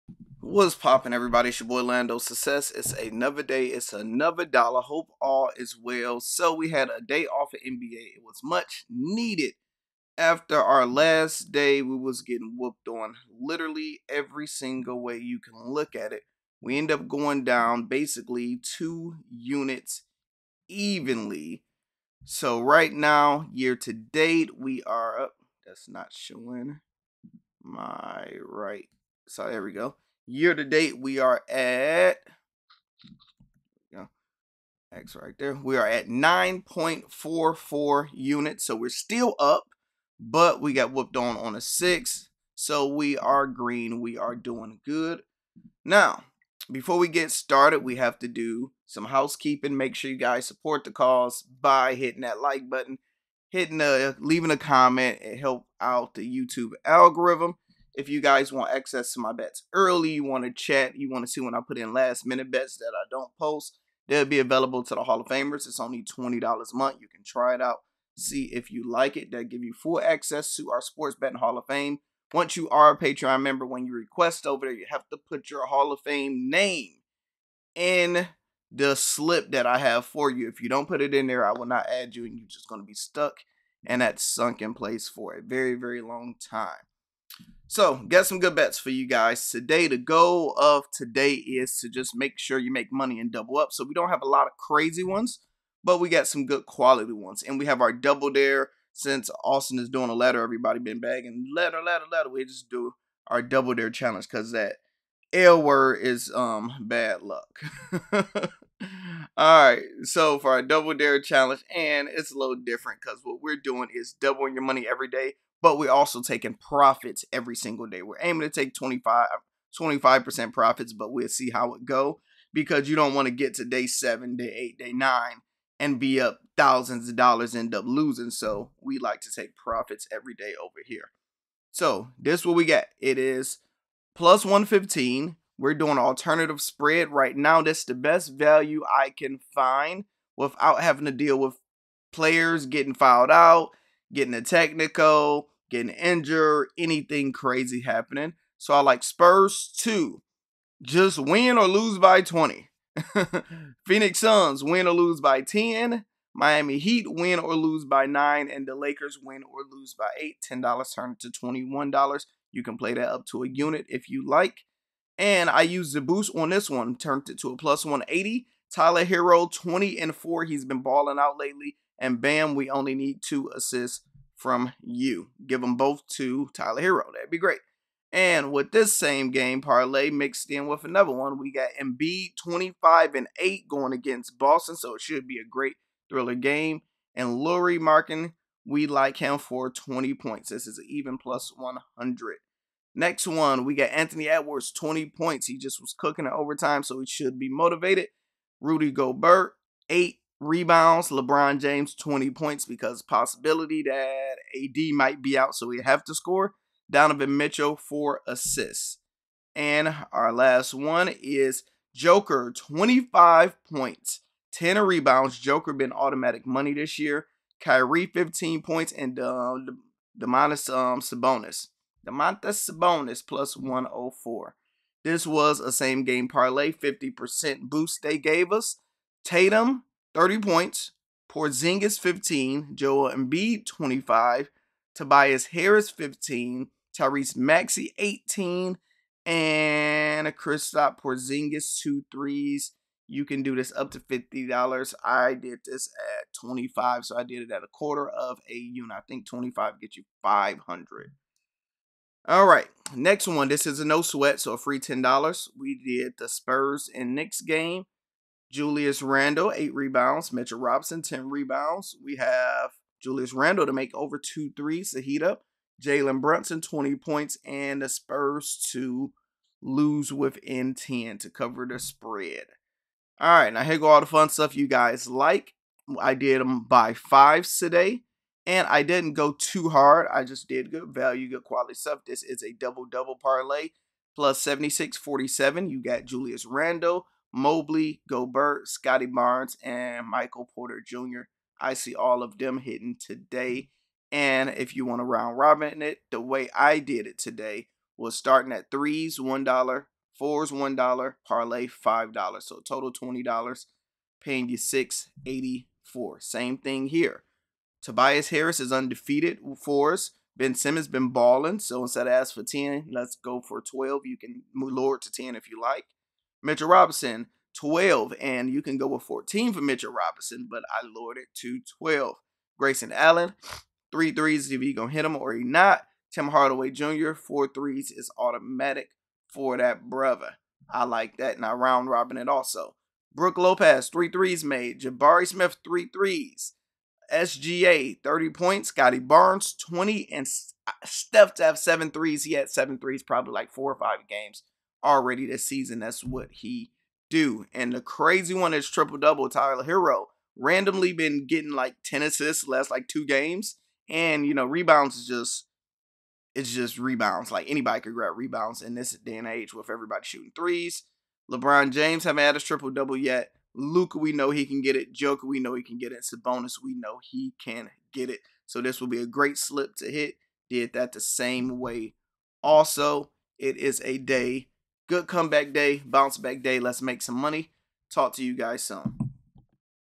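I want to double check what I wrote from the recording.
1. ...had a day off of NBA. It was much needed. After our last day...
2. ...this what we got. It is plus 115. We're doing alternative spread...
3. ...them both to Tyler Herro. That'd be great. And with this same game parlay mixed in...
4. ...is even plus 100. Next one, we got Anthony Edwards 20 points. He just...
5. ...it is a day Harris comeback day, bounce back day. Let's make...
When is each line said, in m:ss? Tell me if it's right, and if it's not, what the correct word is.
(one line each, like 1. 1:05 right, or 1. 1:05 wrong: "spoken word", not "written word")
1. 0:06 right
2. 2:12 right
3. 2:55 right
4. 3:10 right
5. 6:13 wrong: "Good", not "Harris".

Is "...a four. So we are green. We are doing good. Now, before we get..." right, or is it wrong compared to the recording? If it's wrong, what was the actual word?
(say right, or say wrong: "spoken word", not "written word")
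wrong: "six", not "four".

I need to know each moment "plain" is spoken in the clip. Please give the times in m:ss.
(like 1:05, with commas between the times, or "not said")
not said.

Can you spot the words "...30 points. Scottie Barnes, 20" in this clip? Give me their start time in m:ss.
5:38.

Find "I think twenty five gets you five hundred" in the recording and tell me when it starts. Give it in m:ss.
4:08.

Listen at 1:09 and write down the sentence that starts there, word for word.
That give you full access to our Sports Betting Hall of Fame.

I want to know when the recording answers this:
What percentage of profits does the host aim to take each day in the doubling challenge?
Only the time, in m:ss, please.
1:58.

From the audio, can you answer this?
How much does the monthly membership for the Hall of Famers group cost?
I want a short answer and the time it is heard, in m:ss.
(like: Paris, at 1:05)
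$20, at 1:06.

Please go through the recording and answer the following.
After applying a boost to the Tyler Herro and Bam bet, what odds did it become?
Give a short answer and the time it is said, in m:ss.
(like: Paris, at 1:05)
+180, at 2:47.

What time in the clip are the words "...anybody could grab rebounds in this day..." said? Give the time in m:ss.
5:57.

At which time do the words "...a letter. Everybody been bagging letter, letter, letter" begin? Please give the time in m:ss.
1:40.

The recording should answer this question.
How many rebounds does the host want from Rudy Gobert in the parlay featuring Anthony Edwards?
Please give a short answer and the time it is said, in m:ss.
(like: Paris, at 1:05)
8, at 3:19.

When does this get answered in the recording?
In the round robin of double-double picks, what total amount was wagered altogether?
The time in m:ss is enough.
5:02.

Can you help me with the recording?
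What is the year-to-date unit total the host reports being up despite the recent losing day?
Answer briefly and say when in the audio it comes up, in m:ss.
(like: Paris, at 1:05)
9.44 units, at 0:36.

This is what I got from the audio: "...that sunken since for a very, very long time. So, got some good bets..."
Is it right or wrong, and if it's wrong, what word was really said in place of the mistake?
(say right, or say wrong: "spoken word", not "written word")
wrong: "place", not "since".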